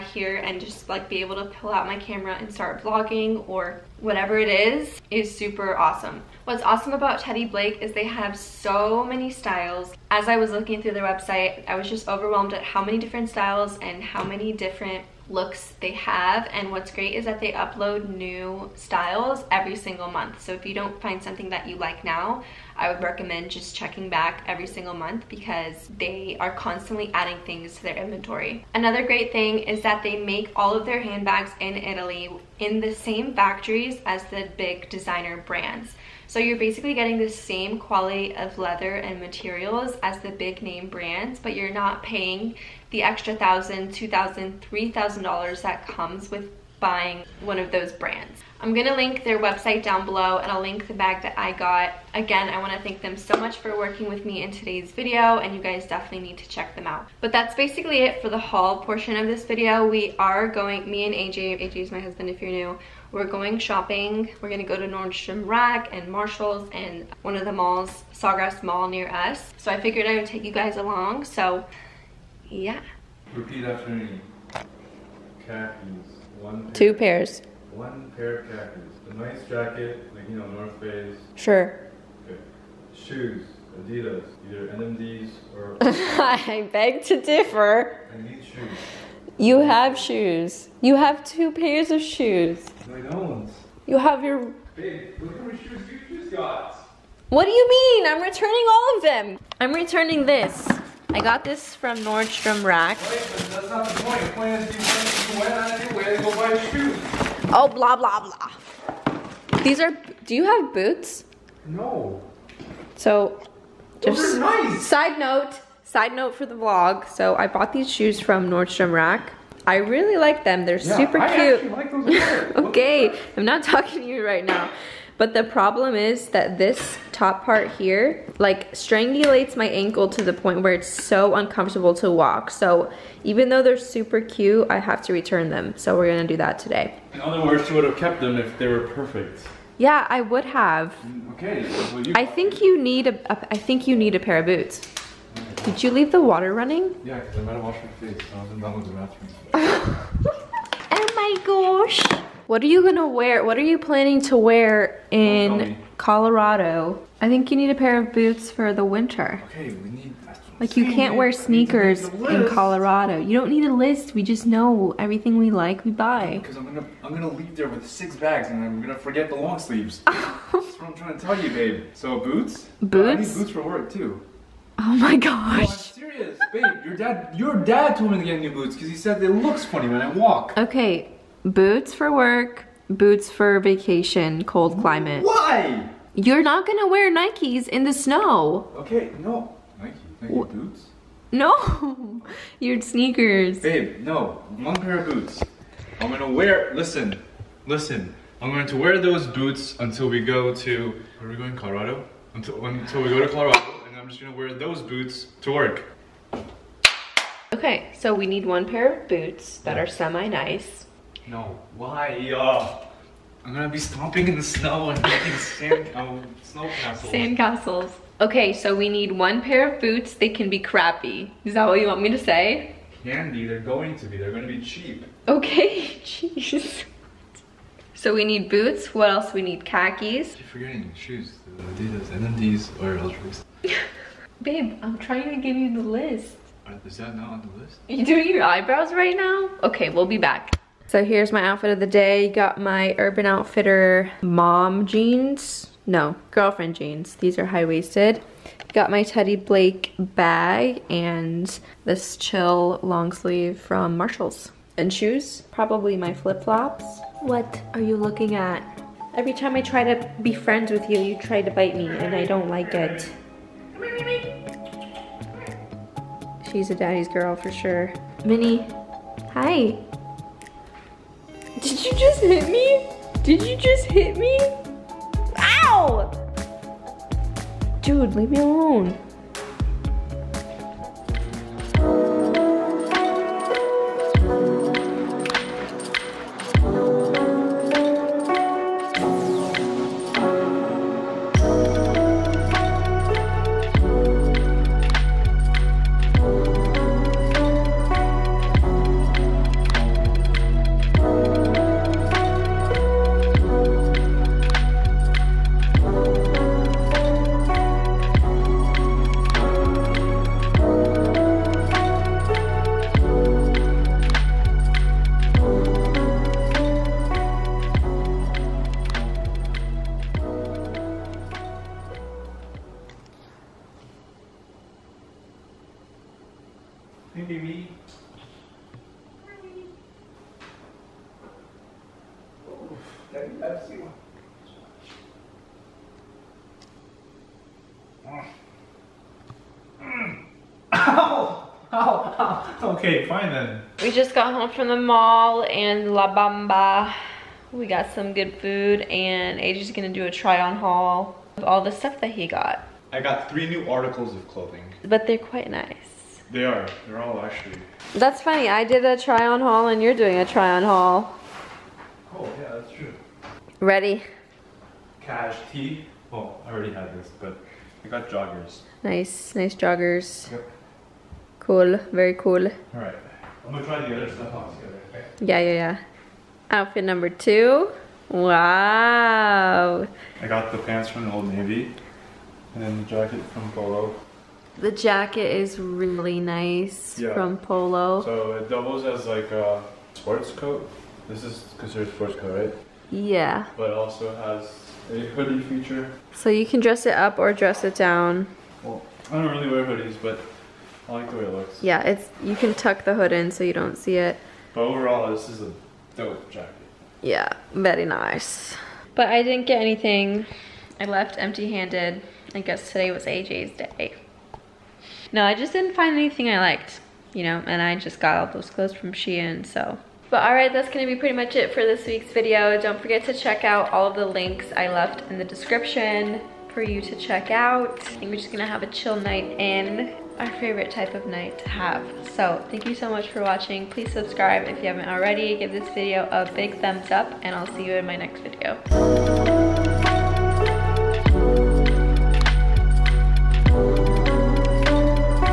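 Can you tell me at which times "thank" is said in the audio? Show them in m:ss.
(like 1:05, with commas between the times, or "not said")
0:52, 7:12.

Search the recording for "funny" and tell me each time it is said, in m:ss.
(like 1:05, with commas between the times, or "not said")
2:59, 5:58.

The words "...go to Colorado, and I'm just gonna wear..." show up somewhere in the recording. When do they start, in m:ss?
3:23.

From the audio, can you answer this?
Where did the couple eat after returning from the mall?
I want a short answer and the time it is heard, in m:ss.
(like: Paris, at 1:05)
La Bamba, at 5:45.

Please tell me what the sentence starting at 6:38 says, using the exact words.
Well, I don't really wear hoodies, but I like the way it looks.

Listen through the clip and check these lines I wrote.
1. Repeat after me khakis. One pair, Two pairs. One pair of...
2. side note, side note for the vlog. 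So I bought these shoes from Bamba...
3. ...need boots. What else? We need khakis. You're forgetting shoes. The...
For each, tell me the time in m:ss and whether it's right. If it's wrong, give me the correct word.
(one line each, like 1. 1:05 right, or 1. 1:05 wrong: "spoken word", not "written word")
1. 1:13 right
2. 1:54 wrong: "Nordstrom", not "Bamba"
3. 3:48 right.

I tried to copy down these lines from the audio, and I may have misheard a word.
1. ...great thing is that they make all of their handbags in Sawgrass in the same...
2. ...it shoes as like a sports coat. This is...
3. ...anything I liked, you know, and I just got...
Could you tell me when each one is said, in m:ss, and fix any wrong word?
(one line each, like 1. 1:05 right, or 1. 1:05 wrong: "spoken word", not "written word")
1. 0:29 wrong: "Italy", not "Sawgrass"
2. 6:28 wrong: "doubles", not "shoes"
3. 6:55 right.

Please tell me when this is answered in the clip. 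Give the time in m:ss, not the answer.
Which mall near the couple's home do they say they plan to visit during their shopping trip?
1:08.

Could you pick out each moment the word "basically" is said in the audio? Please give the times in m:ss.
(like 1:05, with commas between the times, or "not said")
0:36, 0:57.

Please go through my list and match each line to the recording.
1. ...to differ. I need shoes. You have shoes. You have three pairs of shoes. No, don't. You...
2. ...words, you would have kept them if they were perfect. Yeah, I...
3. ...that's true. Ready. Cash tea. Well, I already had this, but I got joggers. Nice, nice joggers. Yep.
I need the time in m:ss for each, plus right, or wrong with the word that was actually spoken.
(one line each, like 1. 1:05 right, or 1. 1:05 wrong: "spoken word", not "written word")
1. 1:27 wrong: "two", not "three"
2. 2:17 right
3. 6:02 right.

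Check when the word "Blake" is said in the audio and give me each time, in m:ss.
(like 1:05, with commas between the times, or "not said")
0:07, 4:09.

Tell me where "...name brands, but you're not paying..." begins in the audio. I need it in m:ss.
0:40.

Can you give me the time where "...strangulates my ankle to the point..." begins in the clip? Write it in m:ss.
2:08.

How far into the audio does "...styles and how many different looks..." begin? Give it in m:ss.
0:13.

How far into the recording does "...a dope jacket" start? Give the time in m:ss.
6:45.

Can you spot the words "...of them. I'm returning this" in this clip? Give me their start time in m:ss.
1:38.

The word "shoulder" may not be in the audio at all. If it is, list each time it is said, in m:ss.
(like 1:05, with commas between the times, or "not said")
not said.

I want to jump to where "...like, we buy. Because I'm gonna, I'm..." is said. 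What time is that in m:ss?
2:45.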